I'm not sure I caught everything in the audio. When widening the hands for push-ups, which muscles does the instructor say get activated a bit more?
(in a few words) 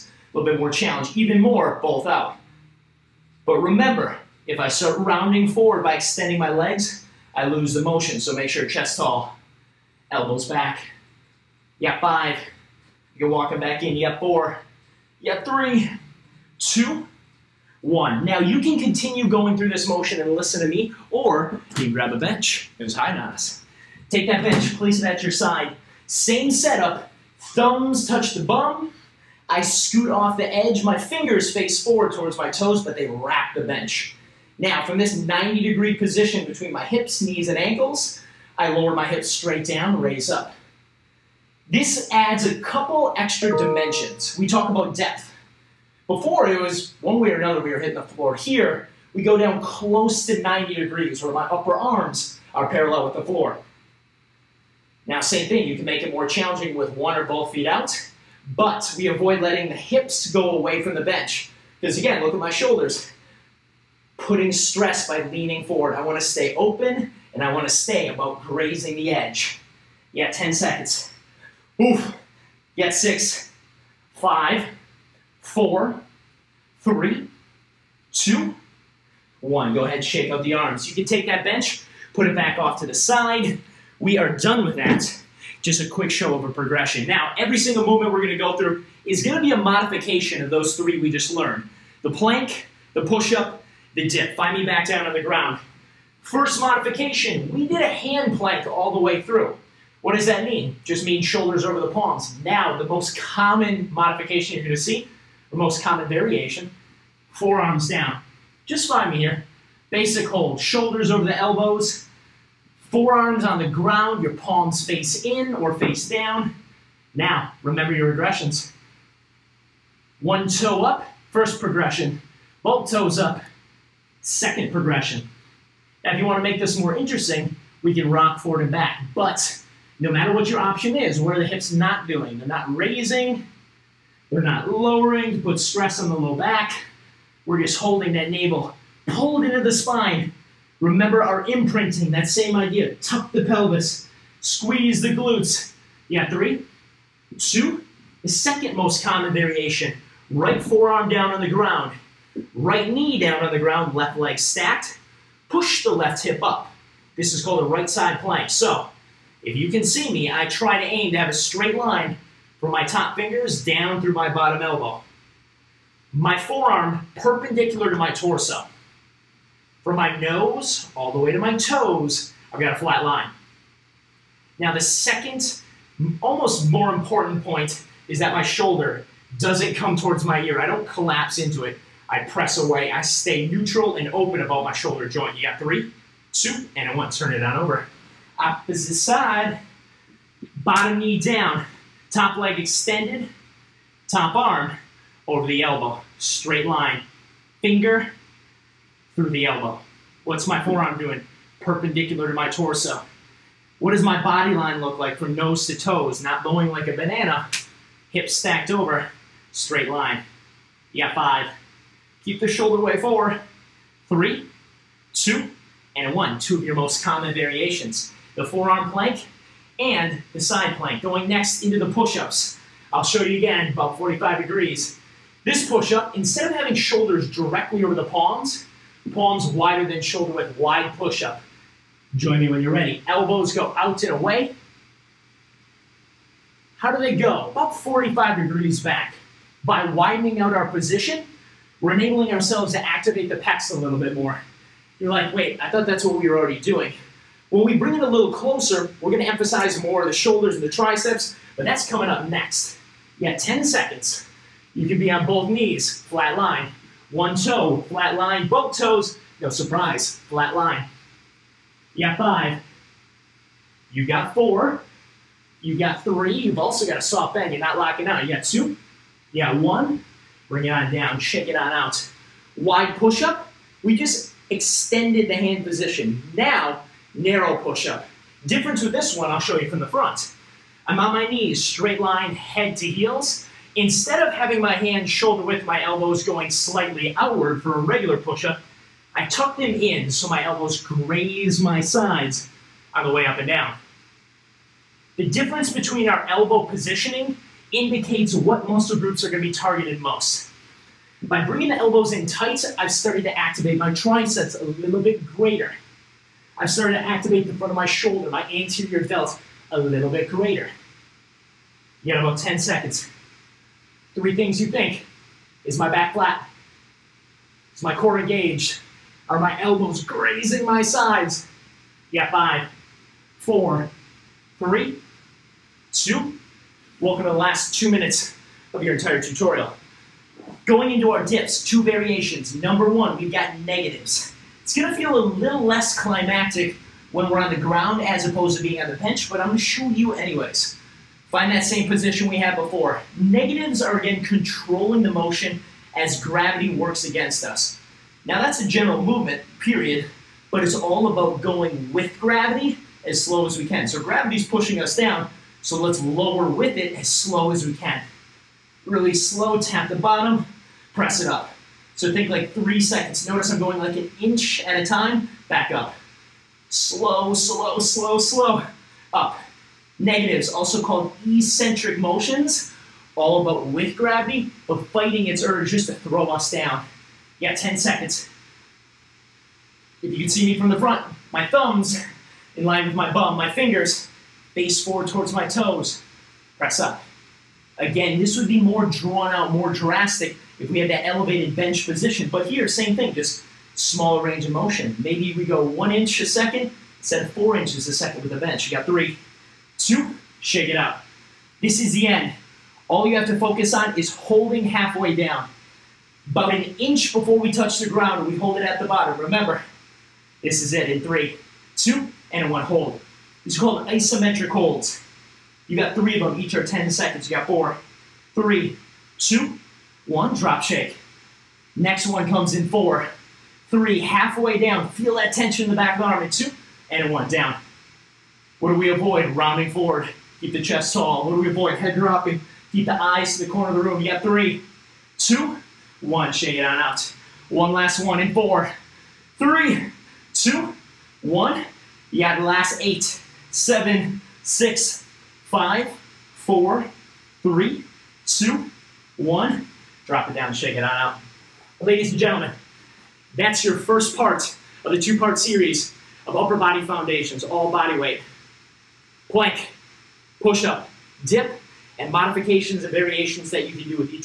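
The pecs.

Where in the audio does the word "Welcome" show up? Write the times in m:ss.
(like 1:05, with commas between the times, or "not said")
5:26.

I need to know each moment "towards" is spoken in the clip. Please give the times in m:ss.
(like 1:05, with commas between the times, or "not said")
0:32, 2:59, 6:25.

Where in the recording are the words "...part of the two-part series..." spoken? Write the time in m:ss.
7:34.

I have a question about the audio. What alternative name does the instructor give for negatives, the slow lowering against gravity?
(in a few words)
Eccentric motions.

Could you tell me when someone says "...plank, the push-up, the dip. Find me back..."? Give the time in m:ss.
1:32.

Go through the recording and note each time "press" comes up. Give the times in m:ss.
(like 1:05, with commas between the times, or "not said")
3:02, 6:00, 6:26.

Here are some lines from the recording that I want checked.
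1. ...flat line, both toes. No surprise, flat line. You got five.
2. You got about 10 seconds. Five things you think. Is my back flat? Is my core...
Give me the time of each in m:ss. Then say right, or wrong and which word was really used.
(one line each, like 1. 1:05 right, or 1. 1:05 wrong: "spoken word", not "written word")
1. 4:17 right
2. 5:12 wrong: "Three", not "Five".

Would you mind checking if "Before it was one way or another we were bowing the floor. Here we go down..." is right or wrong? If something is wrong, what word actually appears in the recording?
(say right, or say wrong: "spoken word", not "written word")
wrong: "hitting", not "bowing".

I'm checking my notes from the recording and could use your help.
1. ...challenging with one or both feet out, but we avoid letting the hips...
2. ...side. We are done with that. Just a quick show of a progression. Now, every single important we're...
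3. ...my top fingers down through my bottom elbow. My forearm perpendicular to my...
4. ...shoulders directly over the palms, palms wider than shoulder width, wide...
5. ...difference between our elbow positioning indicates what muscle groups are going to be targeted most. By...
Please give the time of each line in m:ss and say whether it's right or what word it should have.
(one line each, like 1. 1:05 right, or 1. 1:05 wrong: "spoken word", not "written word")
1. 0:56 right
2. 1:22 wrong: "movement", not "important"
3. 2:42 right
4. 3:46 right
5. 4:55 right.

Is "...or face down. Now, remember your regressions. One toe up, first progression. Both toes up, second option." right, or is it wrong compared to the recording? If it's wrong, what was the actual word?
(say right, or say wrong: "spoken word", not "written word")
wrong: "progression", not "option".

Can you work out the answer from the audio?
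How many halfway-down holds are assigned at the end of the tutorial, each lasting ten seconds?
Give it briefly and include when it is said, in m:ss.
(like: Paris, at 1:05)
3, at 6:55.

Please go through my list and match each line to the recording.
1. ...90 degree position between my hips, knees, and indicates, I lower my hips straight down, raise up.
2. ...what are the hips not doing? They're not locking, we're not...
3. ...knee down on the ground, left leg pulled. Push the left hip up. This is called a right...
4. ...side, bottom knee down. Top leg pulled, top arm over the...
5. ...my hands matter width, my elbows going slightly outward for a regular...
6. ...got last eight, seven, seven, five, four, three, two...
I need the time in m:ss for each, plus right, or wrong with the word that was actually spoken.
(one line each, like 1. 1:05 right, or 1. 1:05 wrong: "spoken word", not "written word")
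1. 0:35 wrong: "ankles", not "indicates"
2. 2:11 wrong: "raising", not "locking"
3. 2:32 wrong: "stacked", not "pulled"
4. 3:08 wrong: "extended", not "pulled"
5. 4:44 wrong: "shoulder", not "matter"
6. 7:22 wrong: "six", not "seven".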